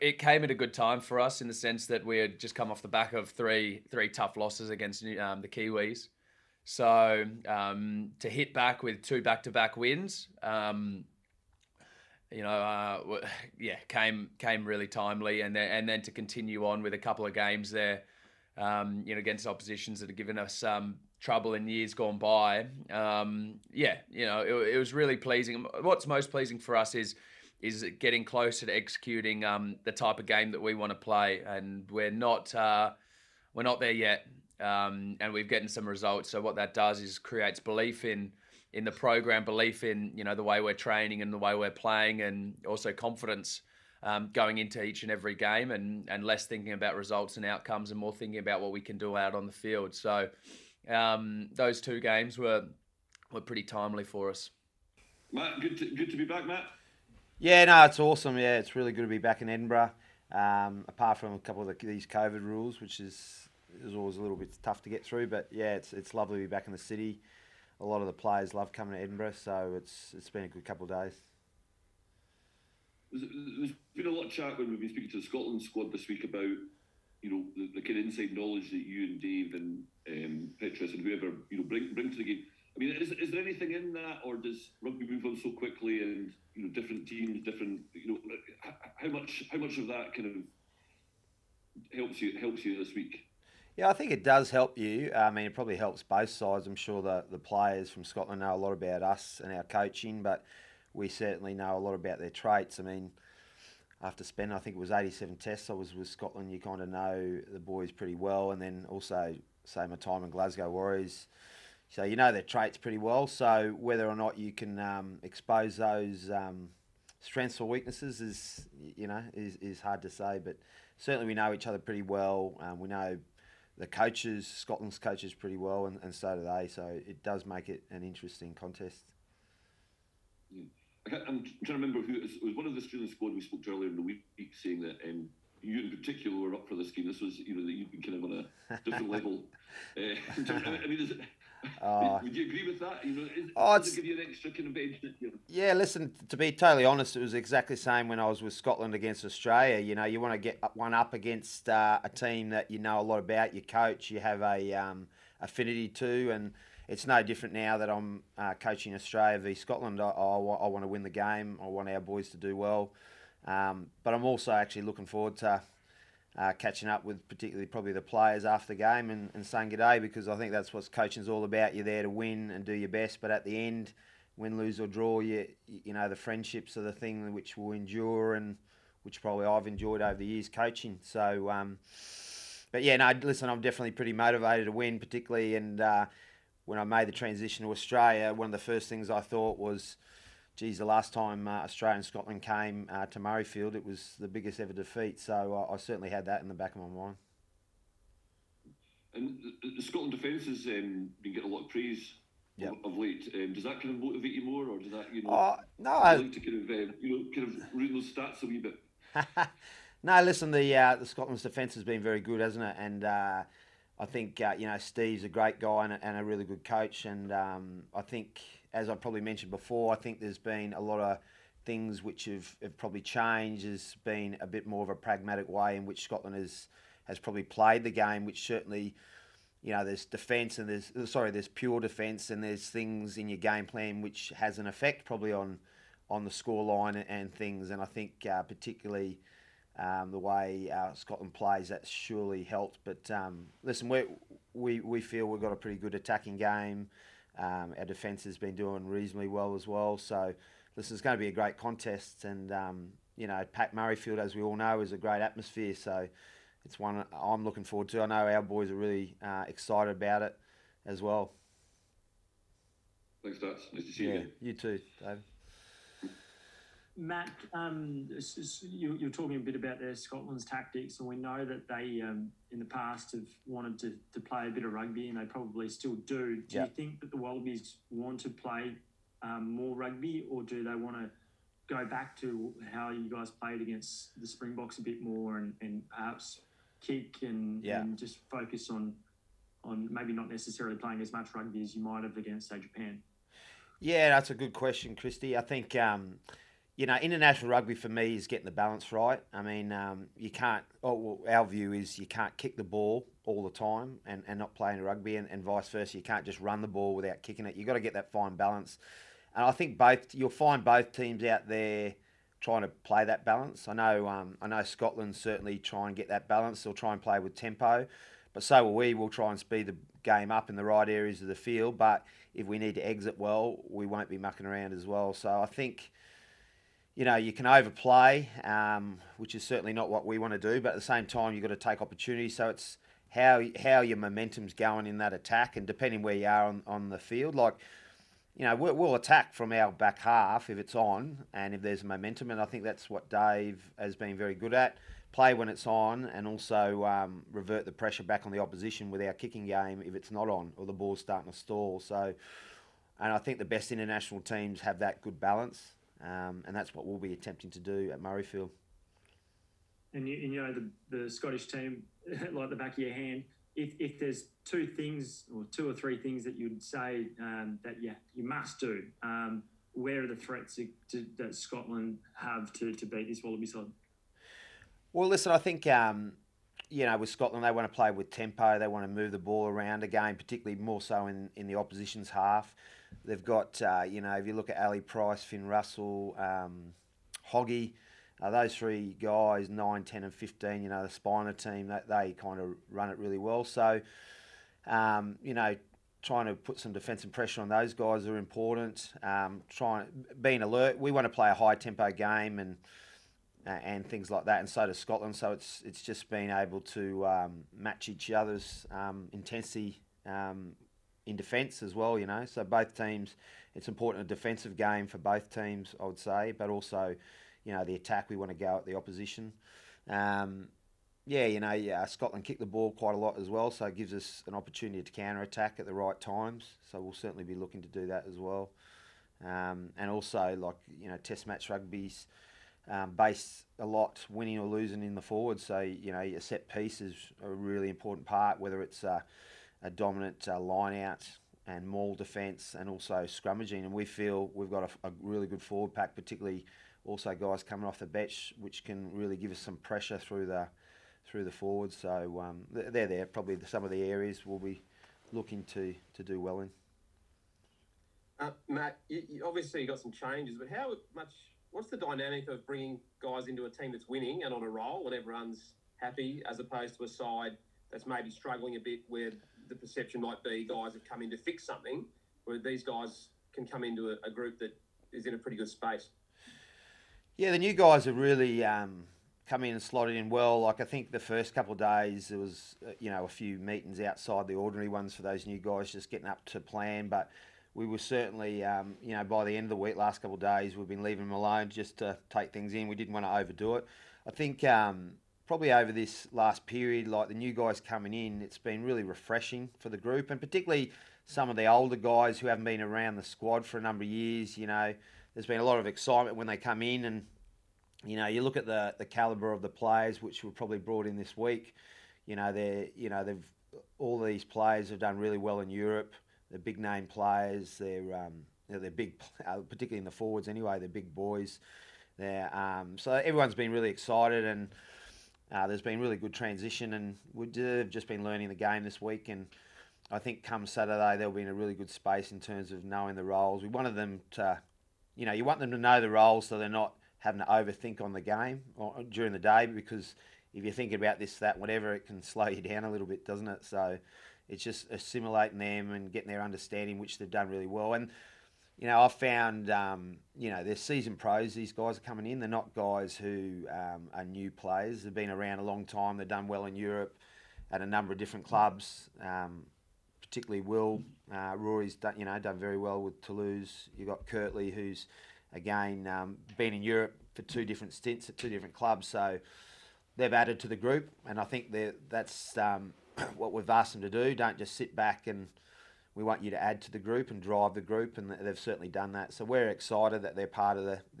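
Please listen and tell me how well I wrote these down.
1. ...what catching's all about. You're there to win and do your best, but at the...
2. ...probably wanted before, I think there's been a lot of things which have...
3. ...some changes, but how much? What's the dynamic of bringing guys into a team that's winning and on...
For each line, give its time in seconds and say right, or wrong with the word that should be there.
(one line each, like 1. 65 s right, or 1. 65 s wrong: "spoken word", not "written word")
1. 170 s wrong: "coaching", not "catching"
2. 218 s wrong: "mentioned", not "wanted"
3. 459 s right.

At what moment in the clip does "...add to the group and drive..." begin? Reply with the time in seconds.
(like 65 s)
576 s.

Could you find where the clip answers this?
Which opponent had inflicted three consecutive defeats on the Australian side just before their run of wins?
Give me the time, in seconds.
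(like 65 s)
5 s.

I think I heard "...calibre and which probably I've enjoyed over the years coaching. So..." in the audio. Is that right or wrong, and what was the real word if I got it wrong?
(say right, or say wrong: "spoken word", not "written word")
wrong: "endure", not "calibre".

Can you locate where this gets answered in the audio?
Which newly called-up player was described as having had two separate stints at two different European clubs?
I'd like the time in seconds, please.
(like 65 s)
564 s.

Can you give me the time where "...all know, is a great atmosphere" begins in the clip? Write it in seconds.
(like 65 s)
254 s.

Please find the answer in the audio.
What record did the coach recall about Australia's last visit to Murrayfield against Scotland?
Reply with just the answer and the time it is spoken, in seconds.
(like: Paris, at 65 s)
Biggest ever defeat, at 194 s.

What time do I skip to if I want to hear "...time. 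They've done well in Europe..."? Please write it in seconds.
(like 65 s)
555 s.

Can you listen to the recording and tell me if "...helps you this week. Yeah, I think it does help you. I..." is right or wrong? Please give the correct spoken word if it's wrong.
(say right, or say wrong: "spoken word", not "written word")
right.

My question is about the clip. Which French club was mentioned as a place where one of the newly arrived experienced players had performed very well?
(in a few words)
Toulouse.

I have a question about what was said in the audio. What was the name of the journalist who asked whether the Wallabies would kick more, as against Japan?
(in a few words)
Christy.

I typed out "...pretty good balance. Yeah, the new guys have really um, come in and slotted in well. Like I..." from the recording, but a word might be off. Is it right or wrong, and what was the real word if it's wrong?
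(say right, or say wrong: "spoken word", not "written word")
wrong: "space", not "balance".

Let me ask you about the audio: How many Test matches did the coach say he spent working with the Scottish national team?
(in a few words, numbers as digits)
87.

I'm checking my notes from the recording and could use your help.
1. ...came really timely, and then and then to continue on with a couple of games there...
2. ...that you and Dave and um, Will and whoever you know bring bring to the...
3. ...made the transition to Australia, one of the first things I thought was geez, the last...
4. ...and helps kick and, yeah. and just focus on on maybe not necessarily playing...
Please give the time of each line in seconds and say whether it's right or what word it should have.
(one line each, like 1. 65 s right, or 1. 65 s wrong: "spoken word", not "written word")
1. 14 s right
2. 78 s wrong: "Petrus", not "Will"
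3. 186 s right
4. 285 s wrong: "perhaps", not "helps".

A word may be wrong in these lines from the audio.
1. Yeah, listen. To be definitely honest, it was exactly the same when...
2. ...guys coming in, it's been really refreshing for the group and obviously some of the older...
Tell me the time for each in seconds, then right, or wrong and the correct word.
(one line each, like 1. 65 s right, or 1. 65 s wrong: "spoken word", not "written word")
1. 145 s wrong: "totally", not "definitely"
2. 497 s wrong: "particularly", not "obviously".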